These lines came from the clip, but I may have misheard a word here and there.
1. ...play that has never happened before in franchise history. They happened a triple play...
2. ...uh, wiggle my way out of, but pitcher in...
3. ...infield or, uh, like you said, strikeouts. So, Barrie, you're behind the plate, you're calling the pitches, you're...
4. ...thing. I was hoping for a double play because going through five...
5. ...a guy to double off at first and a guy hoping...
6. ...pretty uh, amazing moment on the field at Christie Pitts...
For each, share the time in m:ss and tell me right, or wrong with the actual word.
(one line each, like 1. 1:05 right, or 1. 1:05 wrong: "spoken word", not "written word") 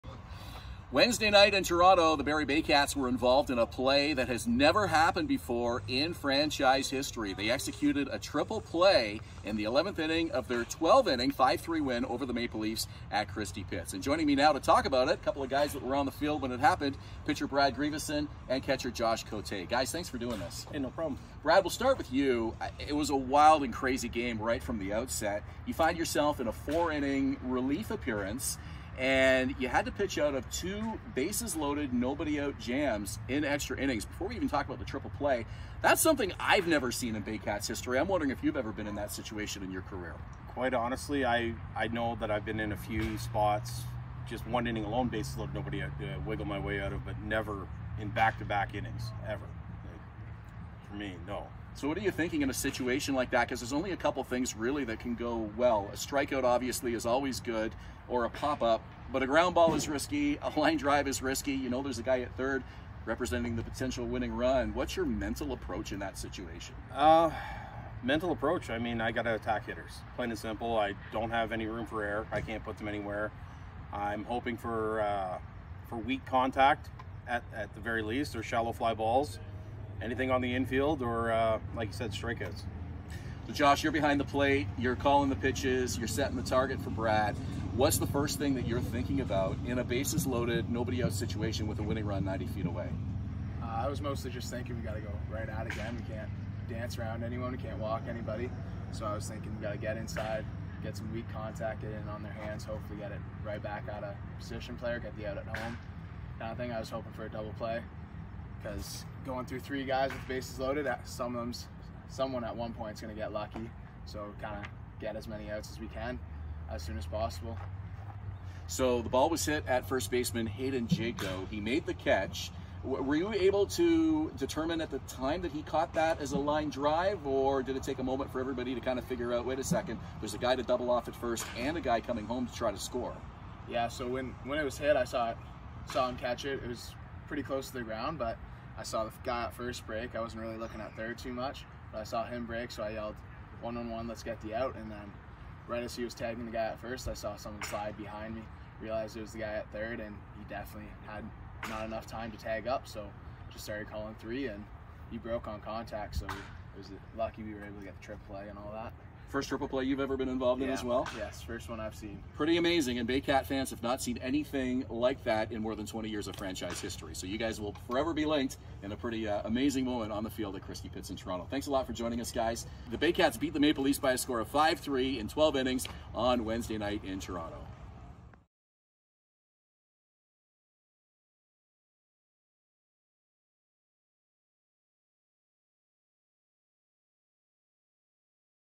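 1. 0:03 wrong: "executed", not "happened"
2. 0:46 wrong: "never", not "pitcher"
3. 1:20 wrong: "Josh", not "Barrie"
4. 1:46 wrong: "three", not "five"
5. 2:10 wrong: "coming", not "hoping"
6. 2:48 right.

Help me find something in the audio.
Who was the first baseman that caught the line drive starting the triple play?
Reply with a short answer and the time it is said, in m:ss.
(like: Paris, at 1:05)
Hayden Jaco, at 2:00.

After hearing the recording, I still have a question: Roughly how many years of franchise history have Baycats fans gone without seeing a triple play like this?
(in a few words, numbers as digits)
More than 20.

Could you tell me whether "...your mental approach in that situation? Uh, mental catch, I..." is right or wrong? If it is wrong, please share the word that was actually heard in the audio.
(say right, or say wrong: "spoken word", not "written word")
wrong: "approach", not "catch".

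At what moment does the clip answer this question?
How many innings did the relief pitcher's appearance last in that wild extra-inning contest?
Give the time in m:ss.
0:26.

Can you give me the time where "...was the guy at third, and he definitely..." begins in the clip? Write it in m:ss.
2:29.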